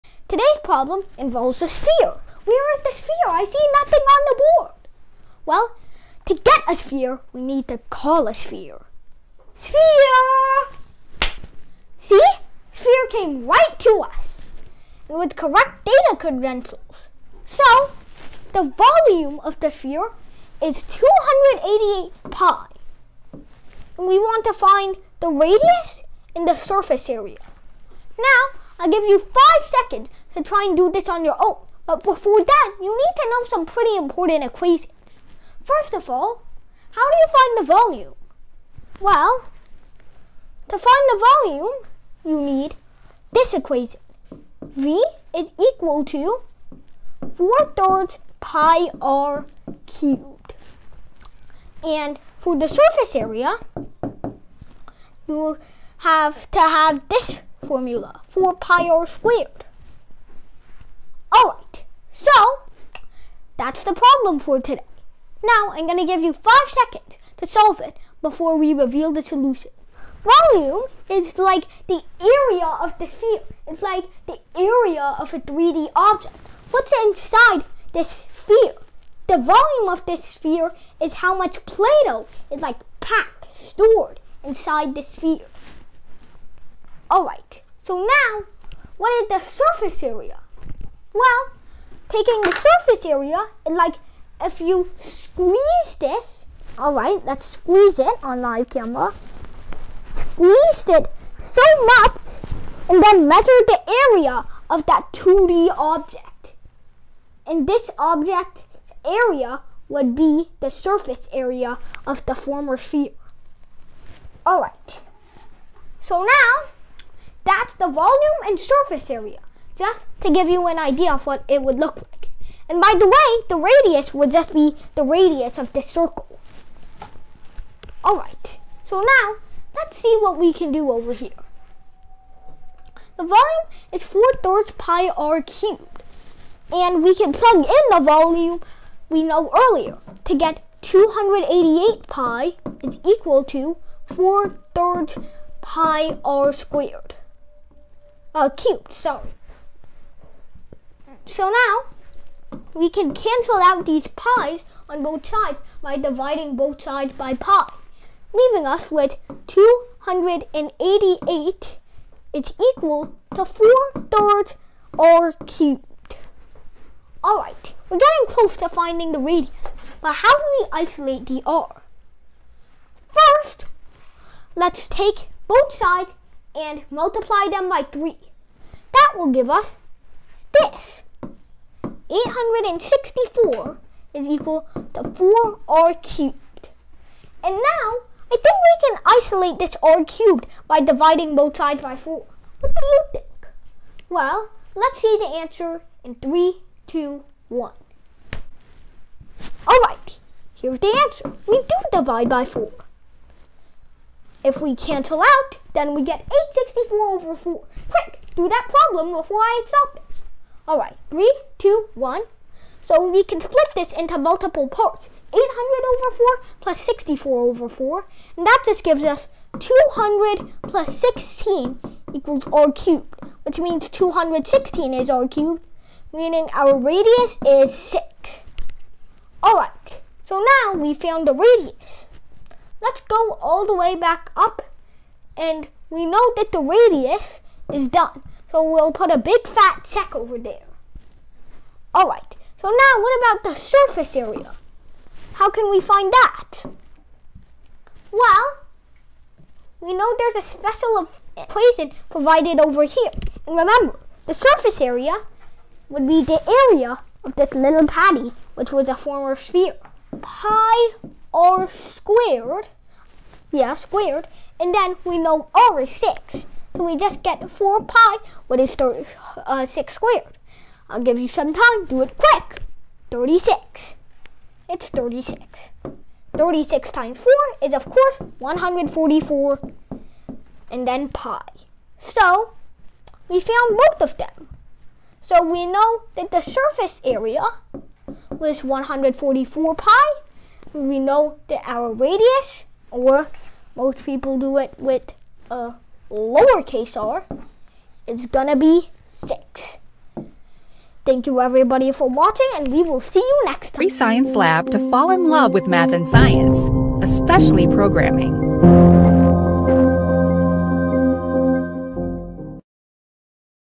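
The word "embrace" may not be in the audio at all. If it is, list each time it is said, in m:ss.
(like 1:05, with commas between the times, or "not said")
not said.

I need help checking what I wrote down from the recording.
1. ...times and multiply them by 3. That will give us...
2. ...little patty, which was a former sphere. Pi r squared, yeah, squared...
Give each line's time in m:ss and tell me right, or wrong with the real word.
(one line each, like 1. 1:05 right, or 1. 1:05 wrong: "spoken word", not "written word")
1. 2:55 wrong: "sides", not "times"
2. 4:17 right.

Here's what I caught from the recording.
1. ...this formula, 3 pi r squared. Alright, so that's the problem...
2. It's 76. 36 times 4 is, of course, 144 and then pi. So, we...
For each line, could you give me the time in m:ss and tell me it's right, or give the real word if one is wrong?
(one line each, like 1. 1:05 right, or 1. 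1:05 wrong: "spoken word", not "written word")
1. 0:57 wrong: "4", not "3"
2. 4:34 wrong: "36", not "76".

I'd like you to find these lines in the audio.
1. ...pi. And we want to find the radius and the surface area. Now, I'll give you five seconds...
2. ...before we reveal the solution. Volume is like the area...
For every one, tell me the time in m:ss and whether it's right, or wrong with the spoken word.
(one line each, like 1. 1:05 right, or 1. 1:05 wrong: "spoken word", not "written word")
1. 0:22 right
2. 1:08 right.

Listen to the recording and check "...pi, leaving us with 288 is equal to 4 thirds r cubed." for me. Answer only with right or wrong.
right.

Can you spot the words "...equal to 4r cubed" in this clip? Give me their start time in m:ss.
3:04.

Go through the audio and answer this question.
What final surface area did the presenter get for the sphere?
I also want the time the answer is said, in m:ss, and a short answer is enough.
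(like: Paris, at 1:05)
144 pi, at 4:48.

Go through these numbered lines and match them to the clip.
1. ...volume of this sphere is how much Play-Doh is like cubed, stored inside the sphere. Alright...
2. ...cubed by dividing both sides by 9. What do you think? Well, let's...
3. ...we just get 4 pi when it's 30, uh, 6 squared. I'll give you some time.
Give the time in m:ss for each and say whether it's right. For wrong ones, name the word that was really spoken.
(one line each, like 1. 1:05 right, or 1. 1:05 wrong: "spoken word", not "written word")
1. 1:19 wrong: "packed", not "cubed"
2. 3:10 wrong: "4", not "9"
3. 4:26 right.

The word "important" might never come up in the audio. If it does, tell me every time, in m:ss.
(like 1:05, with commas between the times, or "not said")
0:33.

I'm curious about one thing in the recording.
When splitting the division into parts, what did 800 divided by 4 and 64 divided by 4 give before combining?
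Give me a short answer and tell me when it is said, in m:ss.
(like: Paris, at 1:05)
200 plus 16, at 3:39.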